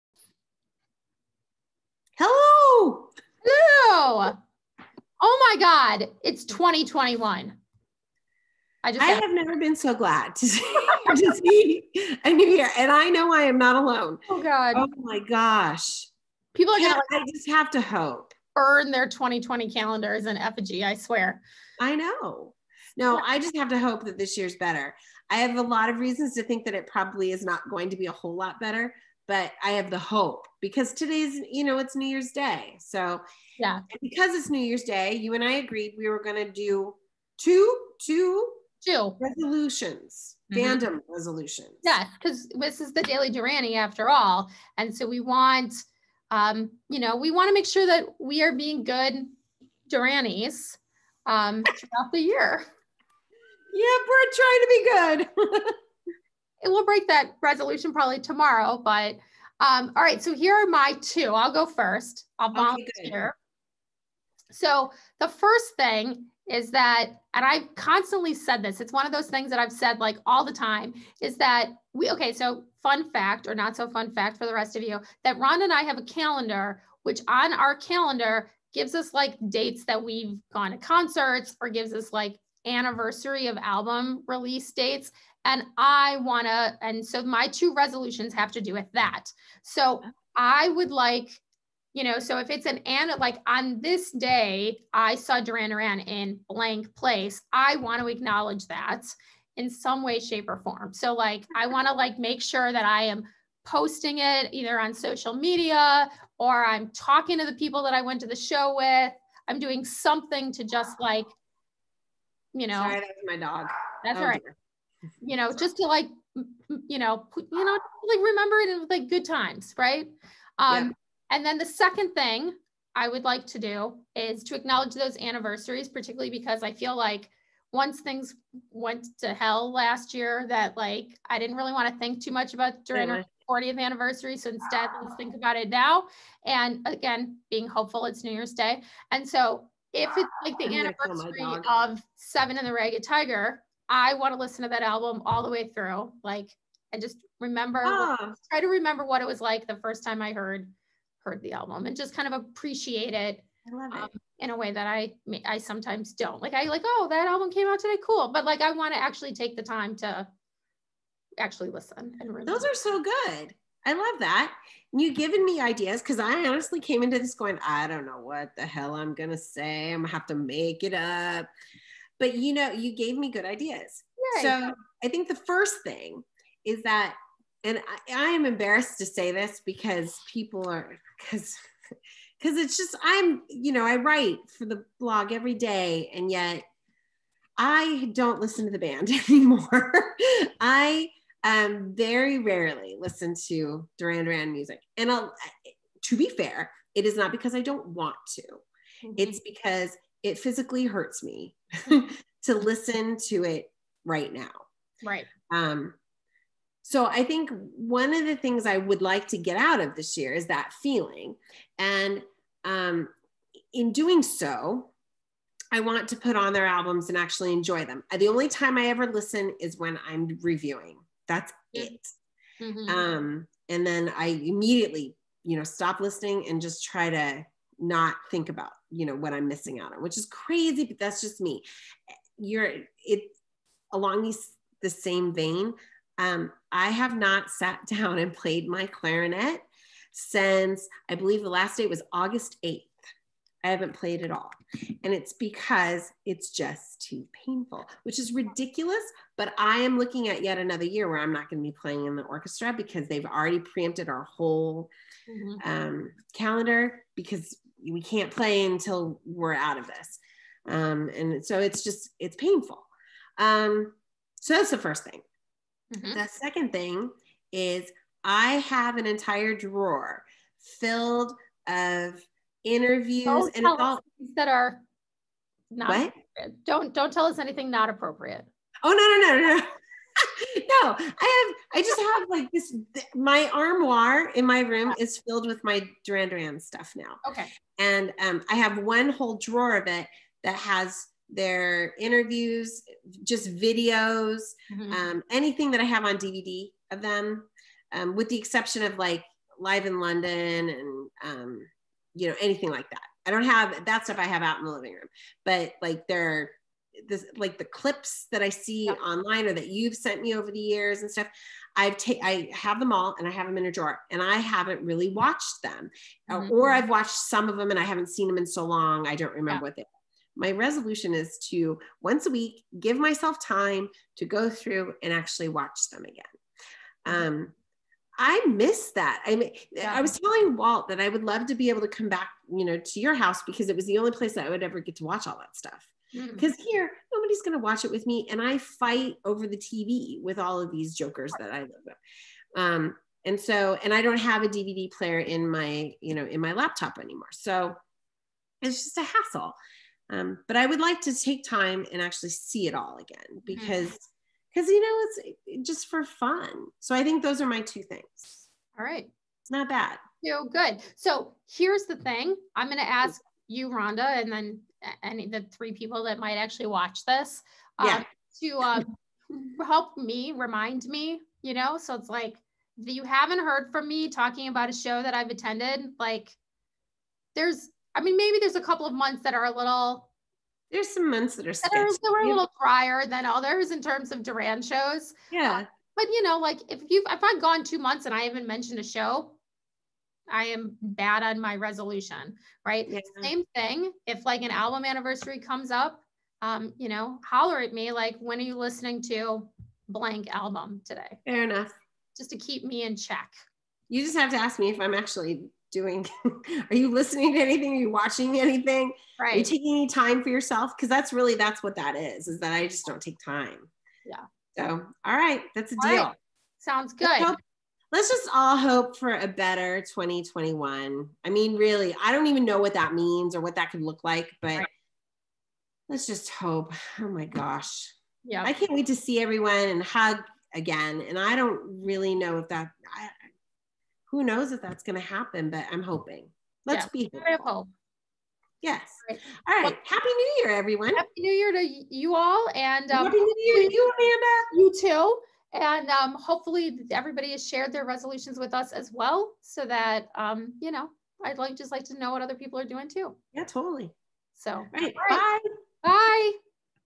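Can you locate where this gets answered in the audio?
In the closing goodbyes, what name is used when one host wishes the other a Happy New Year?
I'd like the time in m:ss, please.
7:23.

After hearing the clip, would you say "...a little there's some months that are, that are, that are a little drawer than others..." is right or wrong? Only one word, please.
wrong.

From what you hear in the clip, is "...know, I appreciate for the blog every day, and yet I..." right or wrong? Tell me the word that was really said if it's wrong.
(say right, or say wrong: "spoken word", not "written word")
wrong: "write", not "appreciate".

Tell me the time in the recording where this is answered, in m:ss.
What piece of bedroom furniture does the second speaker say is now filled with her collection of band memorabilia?
4:43.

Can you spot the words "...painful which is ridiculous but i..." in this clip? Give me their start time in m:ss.
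4:07.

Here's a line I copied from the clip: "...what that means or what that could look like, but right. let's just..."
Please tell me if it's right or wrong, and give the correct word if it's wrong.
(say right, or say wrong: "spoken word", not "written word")
right.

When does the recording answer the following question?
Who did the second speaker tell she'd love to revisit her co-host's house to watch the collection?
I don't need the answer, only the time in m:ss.
5:30.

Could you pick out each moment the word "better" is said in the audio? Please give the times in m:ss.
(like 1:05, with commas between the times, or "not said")
0:24, 0:28, 6:59.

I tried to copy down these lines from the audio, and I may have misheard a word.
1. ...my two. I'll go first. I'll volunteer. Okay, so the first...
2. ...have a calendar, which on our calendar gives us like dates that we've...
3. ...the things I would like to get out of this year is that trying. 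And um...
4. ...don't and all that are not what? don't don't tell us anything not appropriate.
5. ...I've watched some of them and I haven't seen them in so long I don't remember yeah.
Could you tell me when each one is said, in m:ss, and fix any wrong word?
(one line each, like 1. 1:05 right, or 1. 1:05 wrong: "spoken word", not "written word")
1. 1:00 right
2. 1:15 right
3. 3:28 wrong: "feeling", not "trying"
4. 4:33 right
5. 5:16 right.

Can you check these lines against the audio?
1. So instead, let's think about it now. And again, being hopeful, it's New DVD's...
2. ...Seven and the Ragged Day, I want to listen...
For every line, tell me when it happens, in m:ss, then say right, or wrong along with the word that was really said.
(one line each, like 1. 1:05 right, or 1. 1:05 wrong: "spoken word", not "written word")
1. 2:14 wrong: "Year", not "DVD"
2. 2:22 wrong: "Tiger", not "Day".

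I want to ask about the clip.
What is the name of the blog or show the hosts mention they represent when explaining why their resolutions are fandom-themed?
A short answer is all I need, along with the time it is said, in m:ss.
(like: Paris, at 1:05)
Daily Duranie, at 0:43.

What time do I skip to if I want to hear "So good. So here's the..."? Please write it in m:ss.
6:00.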